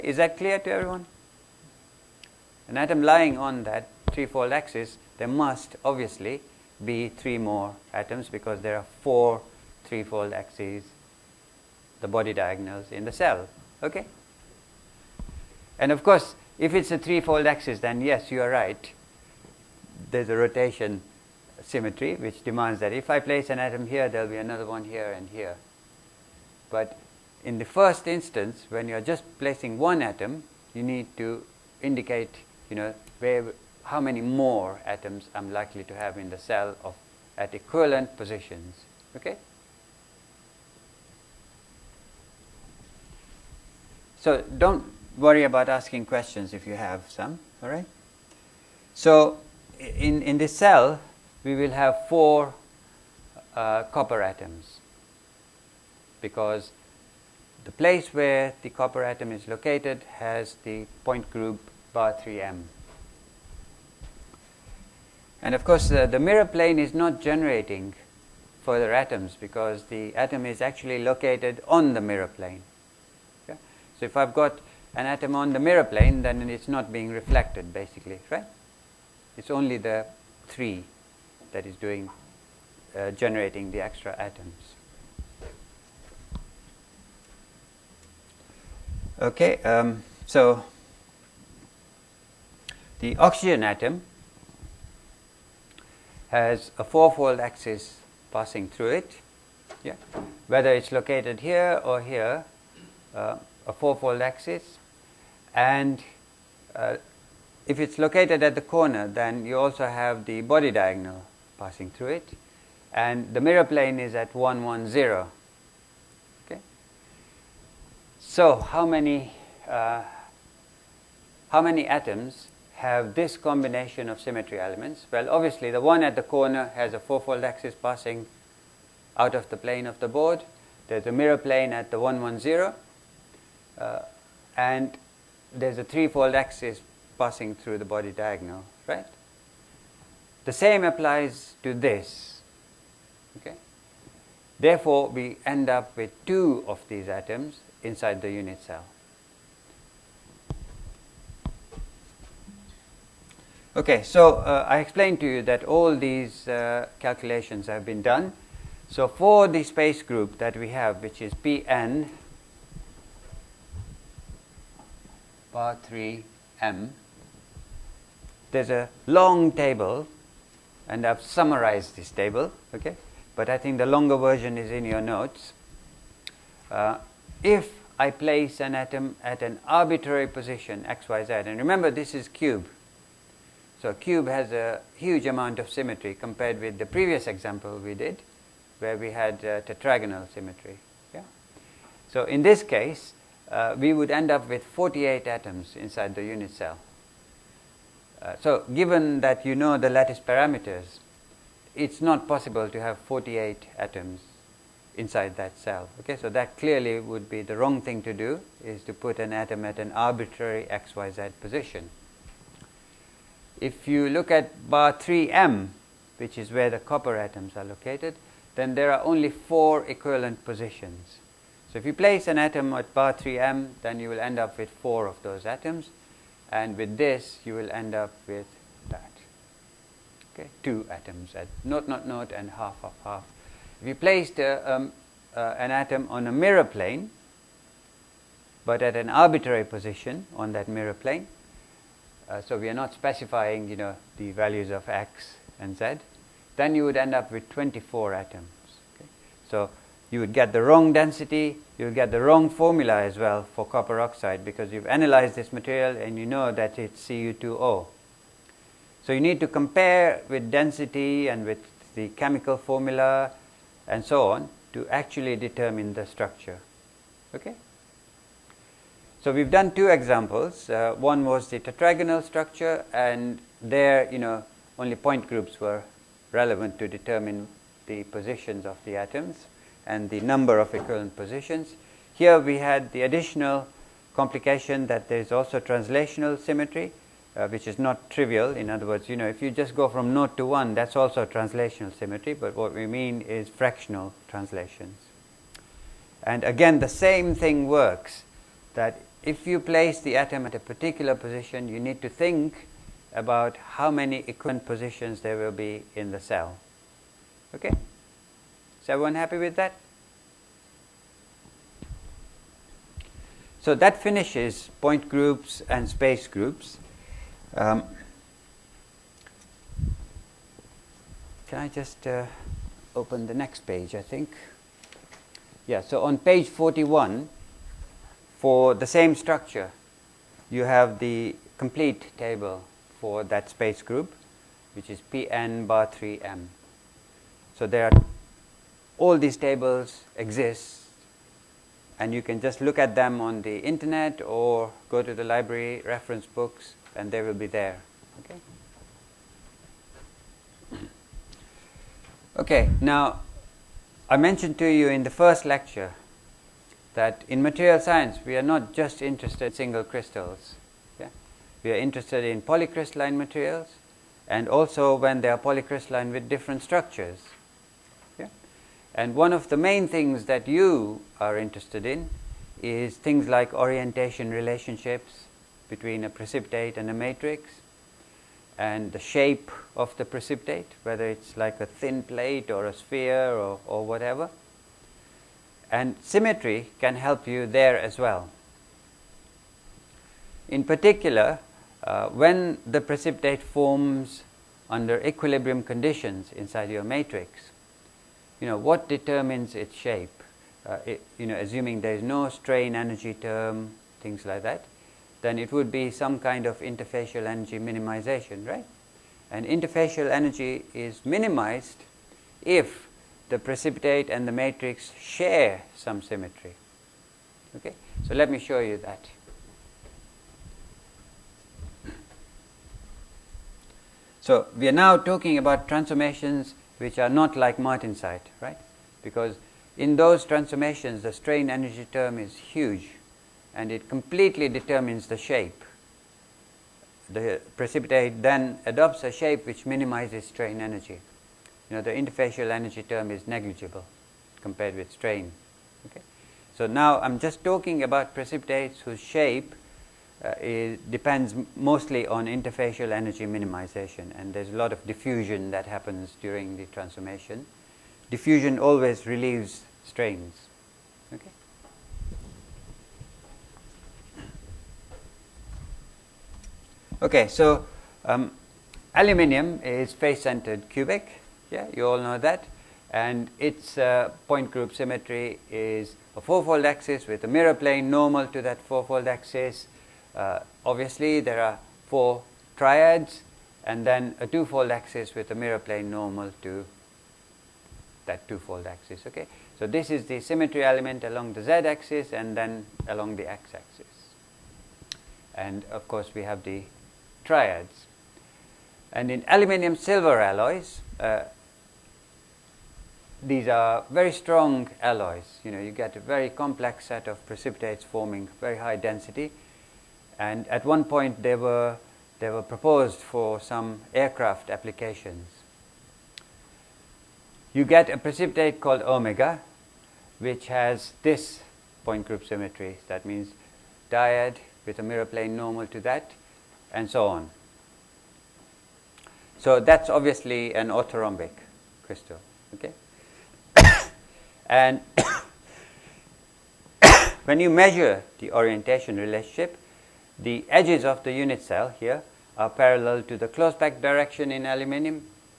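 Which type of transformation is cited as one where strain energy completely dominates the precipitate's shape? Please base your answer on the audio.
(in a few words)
Martensite.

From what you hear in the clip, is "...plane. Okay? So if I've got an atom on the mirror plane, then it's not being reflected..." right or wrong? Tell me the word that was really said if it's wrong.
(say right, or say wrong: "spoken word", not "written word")
right.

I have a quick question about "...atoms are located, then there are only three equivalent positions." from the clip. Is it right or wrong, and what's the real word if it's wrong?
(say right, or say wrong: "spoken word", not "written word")
wrong: "four", not "three".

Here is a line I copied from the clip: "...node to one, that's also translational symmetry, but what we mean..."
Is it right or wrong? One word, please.
right.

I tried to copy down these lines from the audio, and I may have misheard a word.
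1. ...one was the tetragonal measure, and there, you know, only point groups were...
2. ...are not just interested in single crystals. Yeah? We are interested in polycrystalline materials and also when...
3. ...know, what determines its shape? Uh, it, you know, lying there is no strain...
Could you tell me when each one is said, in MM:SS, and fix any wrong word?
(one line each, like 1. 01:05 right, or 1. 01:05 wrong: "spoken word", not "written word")
1. 04:30 wrong: "structure", not "measure"
2. 05:58 right
3. 06:38 wrong: "assuming", not "lying".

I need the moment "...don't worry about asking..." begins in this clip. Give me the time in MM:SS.
00:44.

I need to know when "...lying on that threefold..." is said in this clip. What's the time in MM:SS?
00:03.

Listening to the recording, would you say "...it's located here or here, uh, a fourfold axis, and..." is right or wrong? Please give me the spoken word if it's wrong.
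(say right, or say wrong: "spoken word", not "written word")
right.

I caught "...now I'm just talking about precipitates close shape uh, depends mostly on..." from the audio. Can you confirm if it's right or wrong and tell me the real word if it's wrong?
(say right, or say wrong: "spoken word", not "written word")
wrong: "whose", not "close".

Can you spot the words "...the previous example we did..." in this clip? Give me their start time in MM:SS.
03:06.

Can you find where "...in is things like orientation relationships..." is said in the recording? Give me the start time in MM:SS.
06:11.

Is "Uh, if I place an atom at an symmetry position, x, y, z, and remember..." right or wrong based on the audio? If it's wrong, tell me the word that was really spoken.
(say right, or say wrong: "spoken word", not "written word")
wrong: "arbitrary", not "symmetry".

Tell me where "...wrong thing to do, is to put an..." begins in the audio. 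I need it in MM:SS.
03:27.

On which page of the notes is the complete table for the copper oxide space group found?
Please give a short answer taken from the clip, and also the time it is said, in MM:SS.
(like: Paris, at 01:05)
Page 41, at 05:26.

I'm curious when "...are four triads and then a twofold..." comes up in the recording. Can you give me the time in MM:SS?
08:01.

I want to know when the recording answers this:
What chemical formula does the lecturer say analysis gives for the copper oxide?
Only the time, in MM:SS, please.
04:17.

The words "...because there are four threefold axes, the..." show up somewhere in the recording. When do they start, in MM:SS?
00:08.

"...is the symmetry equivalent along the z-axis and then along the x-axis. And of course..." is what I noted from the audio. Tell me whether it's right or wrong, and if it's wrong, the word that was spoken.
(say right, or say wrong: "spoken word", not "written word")
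wrong: "element", not "equivalent".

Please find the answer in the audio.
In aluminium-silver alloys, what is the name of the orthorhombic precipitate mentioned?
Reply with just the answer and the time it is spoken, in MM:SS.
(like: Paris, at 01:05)
Omega, at 08:38.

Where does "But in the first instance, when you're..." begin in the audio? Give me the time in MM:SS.
00:26.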